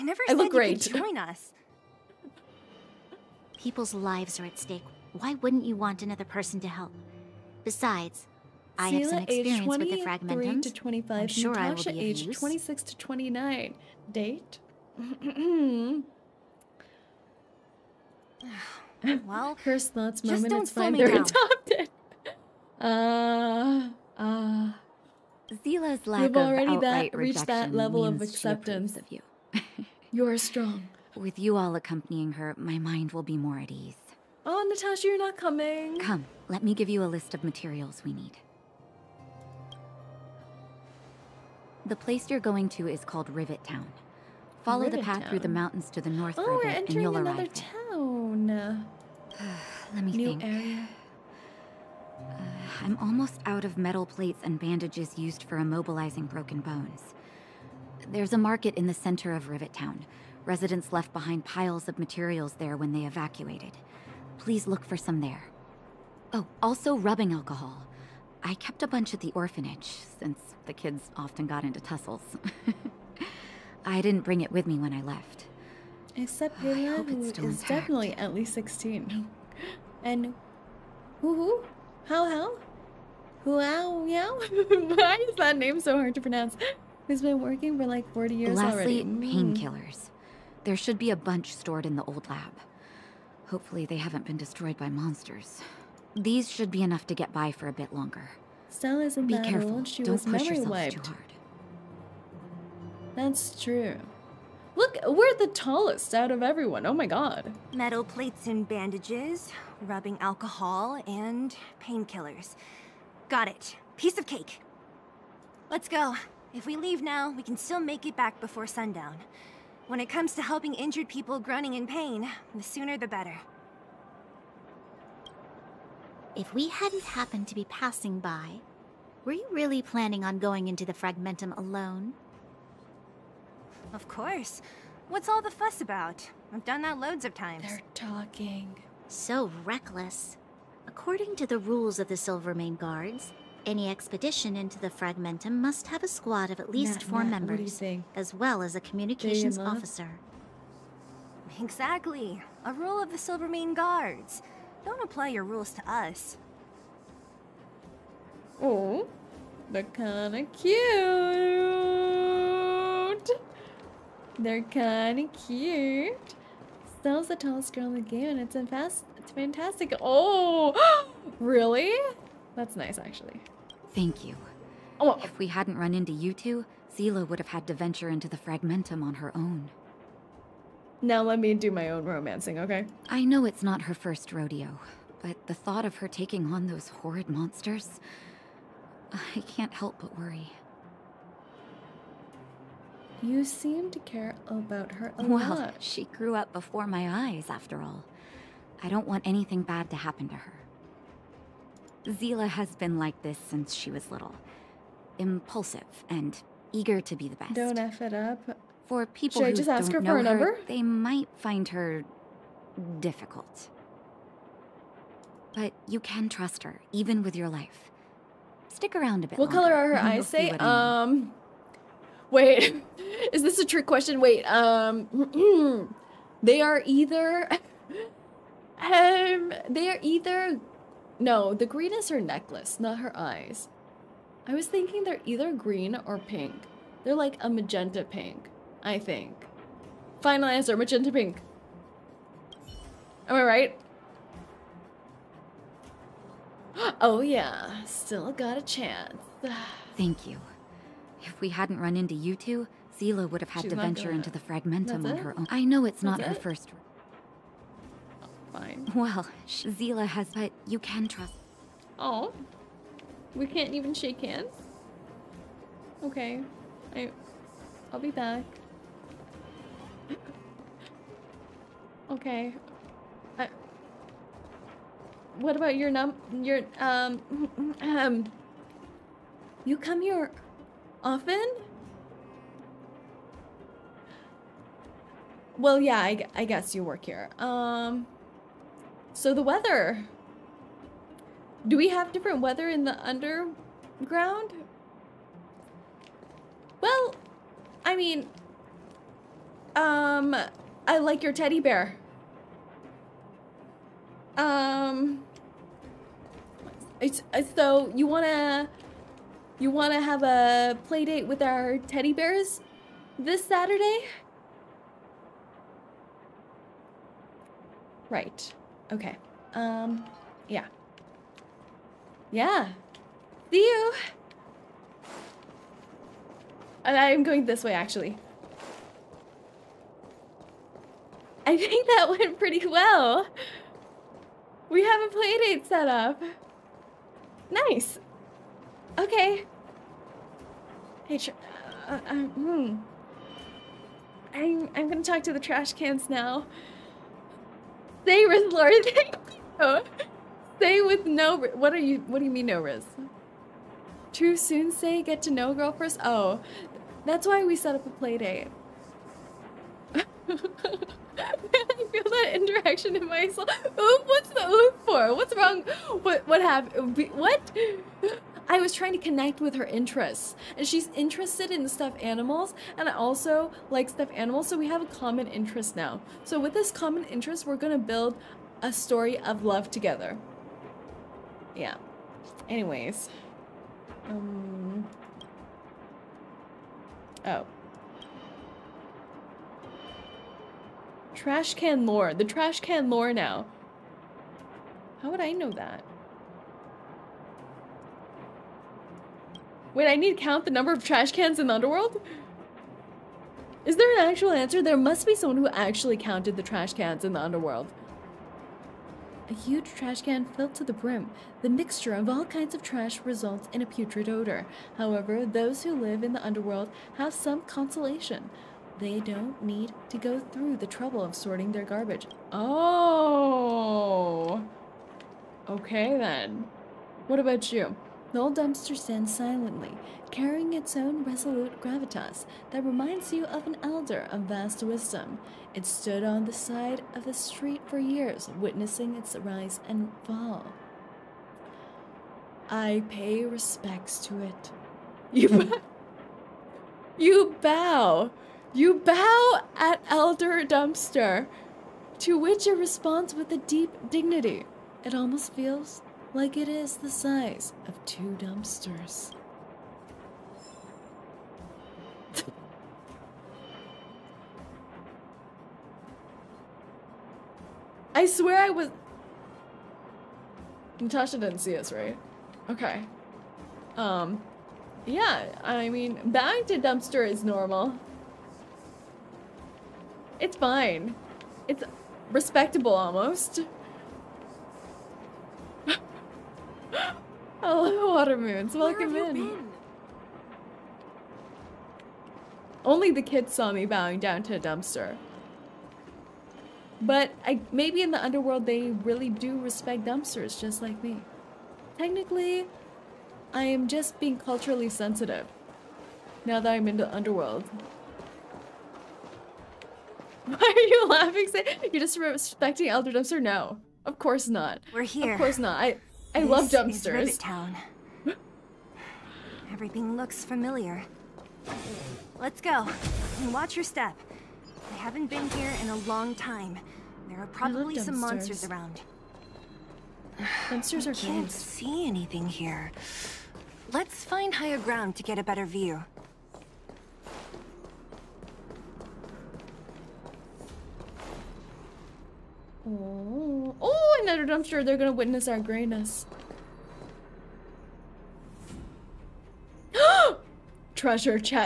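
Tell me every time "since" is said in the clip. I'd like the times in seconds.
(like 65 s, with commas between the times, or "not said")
70 s, 203 s.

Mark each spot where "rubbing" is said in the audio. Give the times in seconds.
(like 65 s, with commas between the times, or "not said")
66 s, 109 s.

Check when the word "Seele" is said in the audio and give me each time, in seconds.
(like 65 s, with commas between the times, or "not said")
25 s, 176 s, 202 s.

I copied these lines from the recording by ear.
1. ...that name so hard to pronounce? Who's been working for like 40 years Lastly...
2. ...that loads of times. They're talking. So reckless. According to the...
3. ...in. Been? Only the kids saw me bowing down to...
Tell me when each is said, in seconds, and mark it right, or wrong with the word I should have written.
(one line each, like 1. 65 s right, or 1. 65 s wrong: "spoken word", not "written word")
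1. 85 s right
2. 136 s right
3. 488 s right.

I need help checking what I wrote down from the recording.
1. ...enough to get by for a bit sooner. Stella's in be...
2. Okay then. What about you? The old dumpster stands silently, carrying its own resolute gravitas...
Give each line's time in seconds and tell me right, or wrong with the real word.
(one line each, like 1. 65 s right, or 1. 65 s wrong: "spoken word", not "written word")
1. 96 s wrong: "longer", not "sooner"
2. 425 s right.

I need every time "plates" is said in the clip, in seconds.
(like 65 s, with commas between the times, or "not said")
54 s, 108 s.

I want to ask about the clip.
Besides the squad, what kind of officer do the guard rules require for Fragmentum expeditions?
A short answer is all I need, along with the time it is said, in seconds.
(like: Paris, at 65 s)
Communications officer, at 148 s.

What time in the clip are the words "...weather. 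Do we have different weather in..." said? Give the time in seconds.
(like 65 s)
289 s.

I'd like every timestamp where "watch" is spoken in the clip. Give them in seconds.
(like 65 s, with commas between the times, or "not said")
523 s.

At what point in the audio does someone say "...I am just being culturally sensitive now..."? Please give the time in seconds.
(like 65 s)
503 s.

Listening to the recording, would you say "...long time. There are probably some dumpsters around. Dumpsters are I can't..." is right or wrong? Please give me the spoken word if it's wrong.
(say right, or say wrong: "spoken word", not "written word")
wrong: "monsters", not "dumpsters".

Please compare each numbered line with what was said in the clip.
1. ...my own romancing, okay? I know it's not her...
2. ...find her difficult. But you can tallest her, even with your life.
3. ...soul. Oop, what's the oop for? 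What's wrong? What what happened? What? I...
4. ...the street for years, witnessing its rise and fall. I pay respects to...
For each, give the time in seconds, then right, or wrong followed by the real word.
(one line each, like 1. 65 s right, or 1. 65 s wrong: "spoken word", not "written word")
1. 181 s right
2. 211 s wrong: "trust", not "tallest"
3. 363 s right
4. 437 s right.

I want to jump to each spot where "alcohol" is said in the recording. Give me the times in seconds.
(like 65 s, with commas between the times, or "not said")
67 s, 110 s.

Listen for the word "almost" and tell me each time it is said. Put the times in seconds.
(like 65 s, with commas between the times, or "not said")
52 s, 454 s, 482 s.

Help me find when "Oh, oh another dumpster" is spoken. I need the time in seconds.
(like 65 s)
542 s.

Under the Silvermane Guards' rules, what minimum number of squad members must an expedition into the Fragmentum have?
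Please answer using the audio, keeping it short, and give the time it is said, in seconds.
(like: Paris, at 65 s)
4, at 147 s.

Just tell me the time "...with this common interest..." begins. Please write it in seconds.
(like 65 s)
376 s.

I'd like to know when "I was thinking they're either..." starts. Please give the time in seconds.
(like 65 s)
234 s.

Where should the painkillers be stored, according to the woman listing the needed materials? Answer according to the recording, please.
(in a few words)
The old lab.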